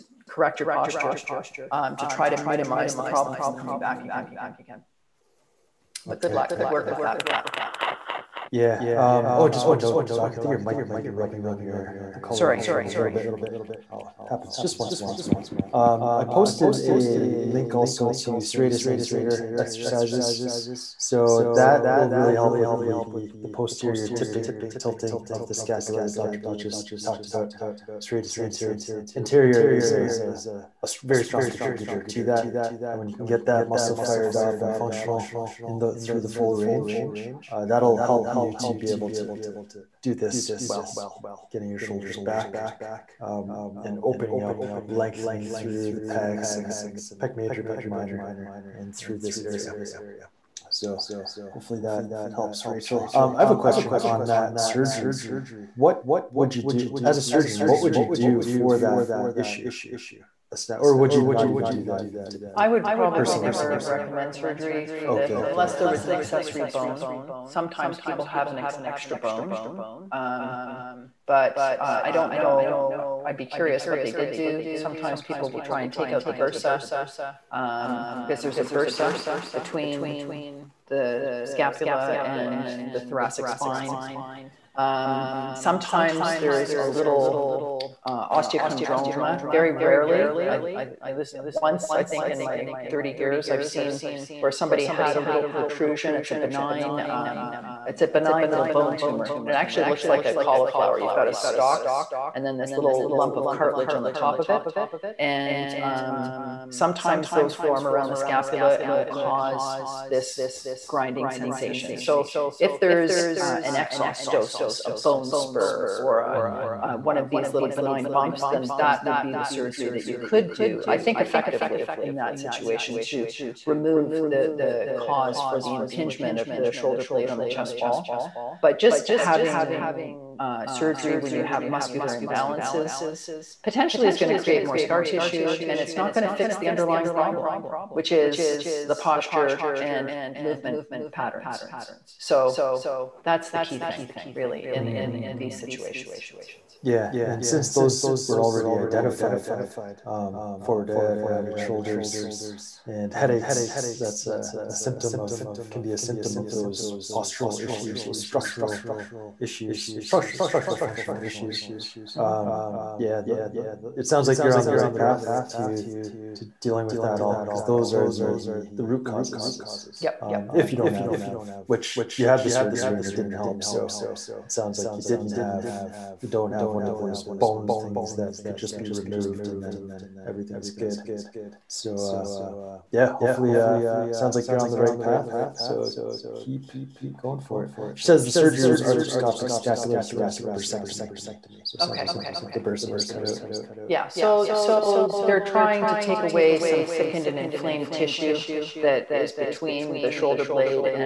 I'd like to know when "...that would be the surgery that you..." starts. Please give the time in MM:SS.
01:58.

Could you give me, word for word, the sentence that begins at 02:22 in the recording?
So that's the key thing, really, in, mm.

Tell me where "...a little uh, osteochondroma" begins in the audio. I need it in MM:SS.
01:26.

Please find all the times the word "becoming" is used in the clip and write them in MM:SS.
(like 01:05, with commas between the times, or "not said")
not said.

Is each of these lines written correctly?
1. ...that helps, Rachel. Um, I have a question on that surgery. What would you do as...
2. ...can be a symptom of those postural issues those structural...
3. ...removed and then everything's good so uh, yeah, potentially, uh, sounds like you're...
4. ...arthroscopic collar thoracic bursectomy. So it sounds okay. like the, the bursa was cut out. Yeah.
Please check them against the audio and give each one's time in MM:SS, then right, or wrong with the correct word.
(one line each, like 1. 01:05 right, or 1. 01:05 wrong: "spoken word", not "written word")
1. 00:51 right
2. 02:35 right
3. 02:58 wrong: "hopefully", not "potentially"
4. 03:08 wrong: "scapular", not "collar".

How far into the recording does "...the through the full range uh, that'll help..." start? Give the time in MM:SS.
00:35.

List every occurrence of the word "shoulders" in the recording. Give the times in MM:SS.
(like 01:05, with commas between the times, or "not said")
00:41, 02:06, 02:31, 03:20.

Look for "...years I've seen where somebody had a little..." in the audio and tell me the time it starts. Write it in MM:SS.
01:33.